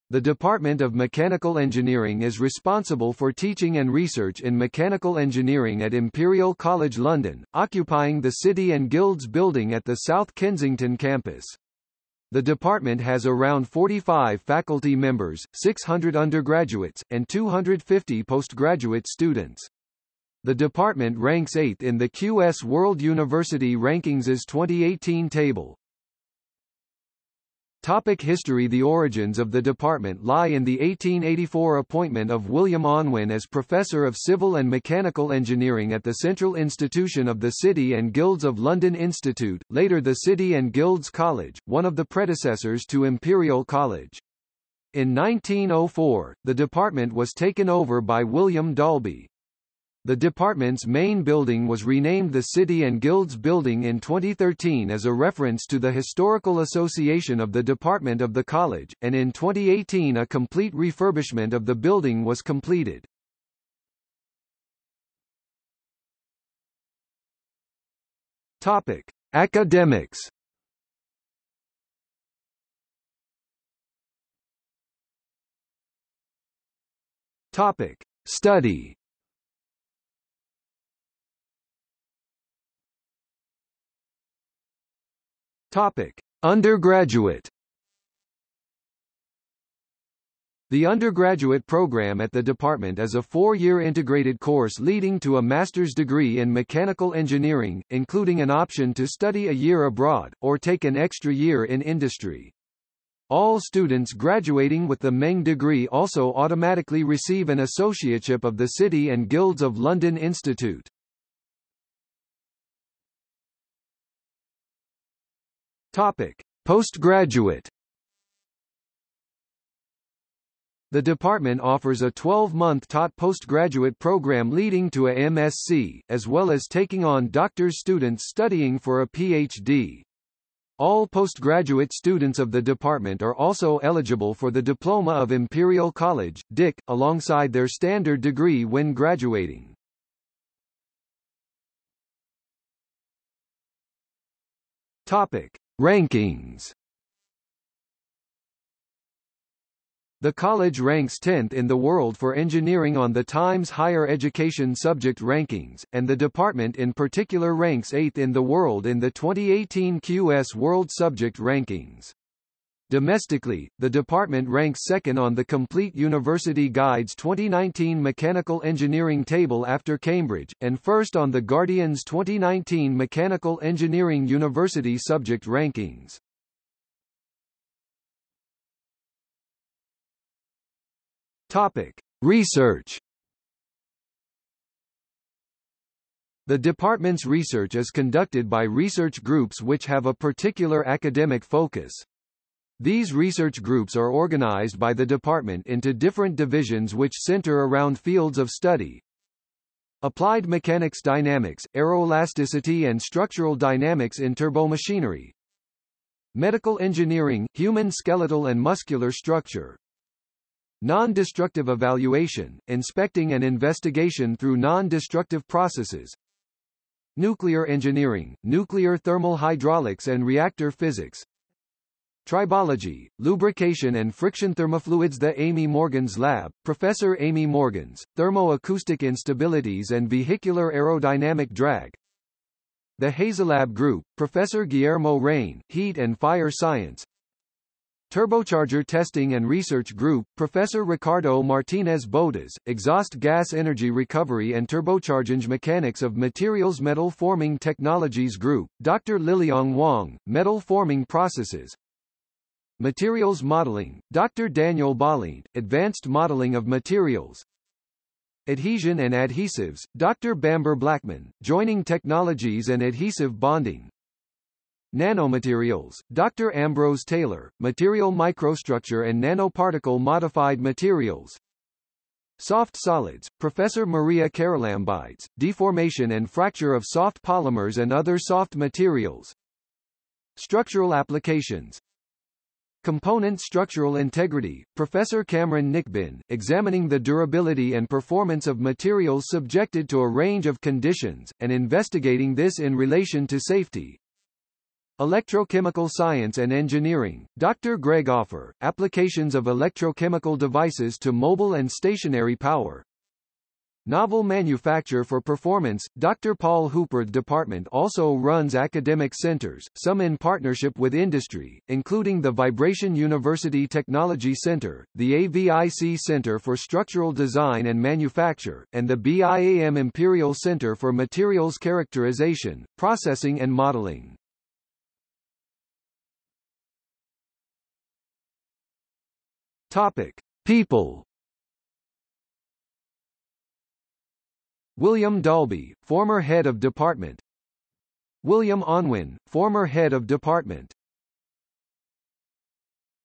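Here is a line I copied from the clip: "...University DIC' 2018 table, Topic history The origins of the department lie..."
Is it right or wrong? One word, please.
wrong.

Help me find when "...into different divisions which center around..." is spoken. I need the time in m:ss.
3:15.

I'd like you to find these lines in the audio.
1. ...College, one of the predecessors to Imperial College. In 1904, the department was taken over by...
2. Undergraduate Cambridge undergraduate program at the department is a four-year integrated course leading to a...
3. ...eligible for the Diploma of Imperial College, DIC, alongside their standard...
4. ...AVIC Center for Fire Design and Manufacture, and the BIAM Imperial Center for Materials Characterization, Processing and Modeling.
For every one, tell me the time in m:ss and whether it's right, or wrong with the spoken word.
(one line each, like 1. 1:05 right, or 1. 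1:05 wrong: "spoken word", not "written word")
1. 0:41 right
2. 1:26 wrong: "The", not "Cambridge"
3. 2:13 right
4. 5:15 wrong: "Structural", not "Fire".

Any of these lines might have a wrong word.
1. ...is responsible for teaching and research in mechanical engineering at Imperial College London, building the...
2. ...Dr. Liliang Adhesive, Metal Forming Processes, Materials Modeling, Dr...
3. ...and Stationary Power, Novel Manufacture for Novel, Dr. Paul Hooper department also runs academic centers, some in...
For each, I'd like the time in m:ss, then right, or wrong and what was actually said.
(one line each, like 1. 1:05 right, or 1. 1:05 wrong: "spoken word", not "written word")
1. 0:02 wrong: "occupying", not "building"
2. 4:08 wrong: "Wang", not "Adhesive"
3. 5:01 wrong: "Performance", not "Novel".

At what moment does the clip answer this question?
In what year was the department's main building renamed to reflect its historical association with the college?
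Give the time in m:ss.
0:53.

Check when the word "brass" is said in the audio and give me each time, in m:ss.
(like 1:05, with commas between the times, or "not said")
not said.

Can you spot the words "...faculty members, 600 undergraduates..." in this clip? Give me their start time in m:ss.
0:14.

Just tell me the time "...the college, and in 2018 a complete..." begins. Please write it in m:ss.
0:58.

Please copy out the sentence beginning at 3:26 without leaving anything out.
Medical engineering, human skeletal and muscular structure.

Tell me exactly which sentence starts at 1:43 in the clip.
All students graduating with the MEng degree also automatically receive an associateship of the City and Guilds of London Institute.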